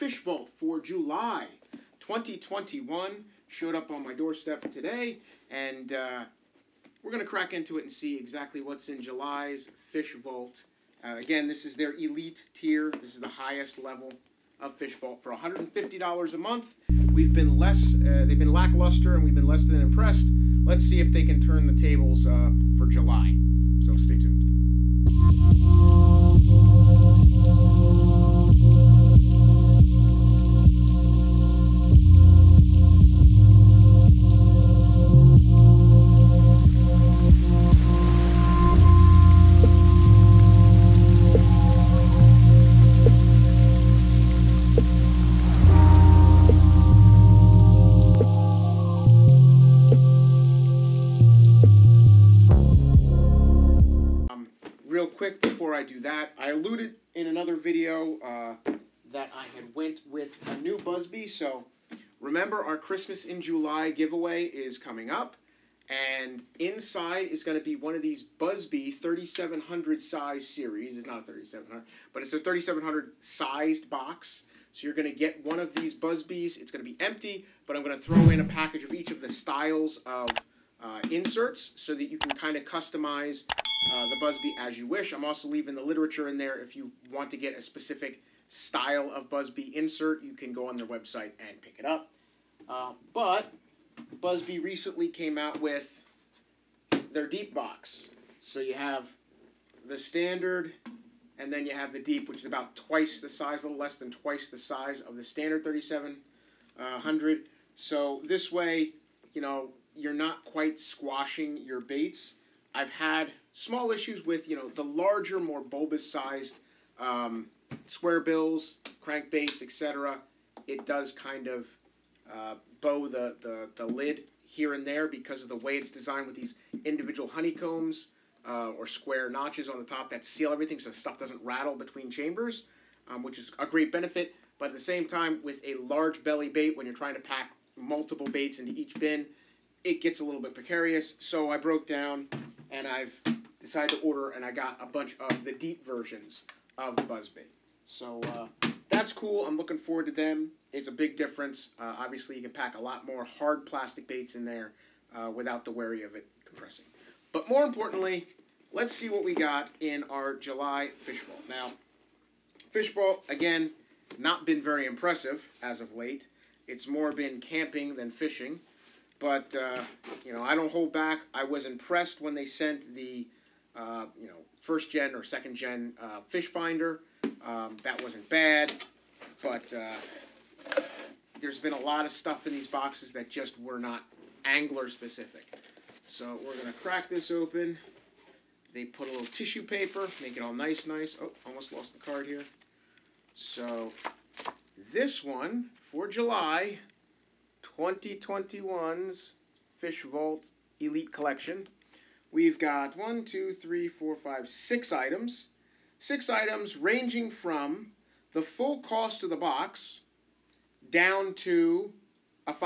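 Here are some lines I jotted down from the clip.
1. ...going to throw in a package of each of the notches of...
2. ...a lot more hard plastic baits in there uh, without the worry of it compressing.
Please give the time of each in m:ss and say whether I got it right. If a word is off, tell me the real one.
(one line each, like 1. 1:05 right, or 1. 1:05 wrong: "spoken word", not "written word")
1. 1:17 wrong: "styles", not "notches"
2. 2:32 right.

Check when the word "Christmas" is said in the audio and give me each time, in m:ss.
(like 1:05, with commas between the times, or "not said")
1:02.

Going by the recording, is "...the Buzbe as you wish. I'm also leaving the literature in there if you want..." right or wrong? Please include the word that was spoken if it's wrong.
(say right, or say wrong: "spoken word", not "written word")
right.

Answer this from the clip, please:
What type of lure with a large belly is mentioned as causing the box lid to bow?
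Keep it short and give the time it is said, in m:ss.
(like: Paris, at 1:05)
square bills, at 1:57.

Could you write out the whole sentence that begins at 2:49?
But, uh, you know, I don't hold back.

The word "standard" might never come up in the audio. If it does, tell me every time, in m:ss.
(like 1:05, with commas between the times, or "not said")
1:39, 1:45.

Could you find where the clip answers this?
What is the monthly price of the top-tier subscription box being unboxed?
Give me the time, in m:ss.
0:15.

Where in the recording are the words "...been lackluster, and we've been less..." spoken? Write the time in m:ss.
0:18.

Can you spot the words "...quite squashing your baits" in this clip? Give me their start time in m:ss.
1:50.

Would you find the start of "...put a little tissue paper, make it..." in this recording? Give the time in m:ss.
3:08.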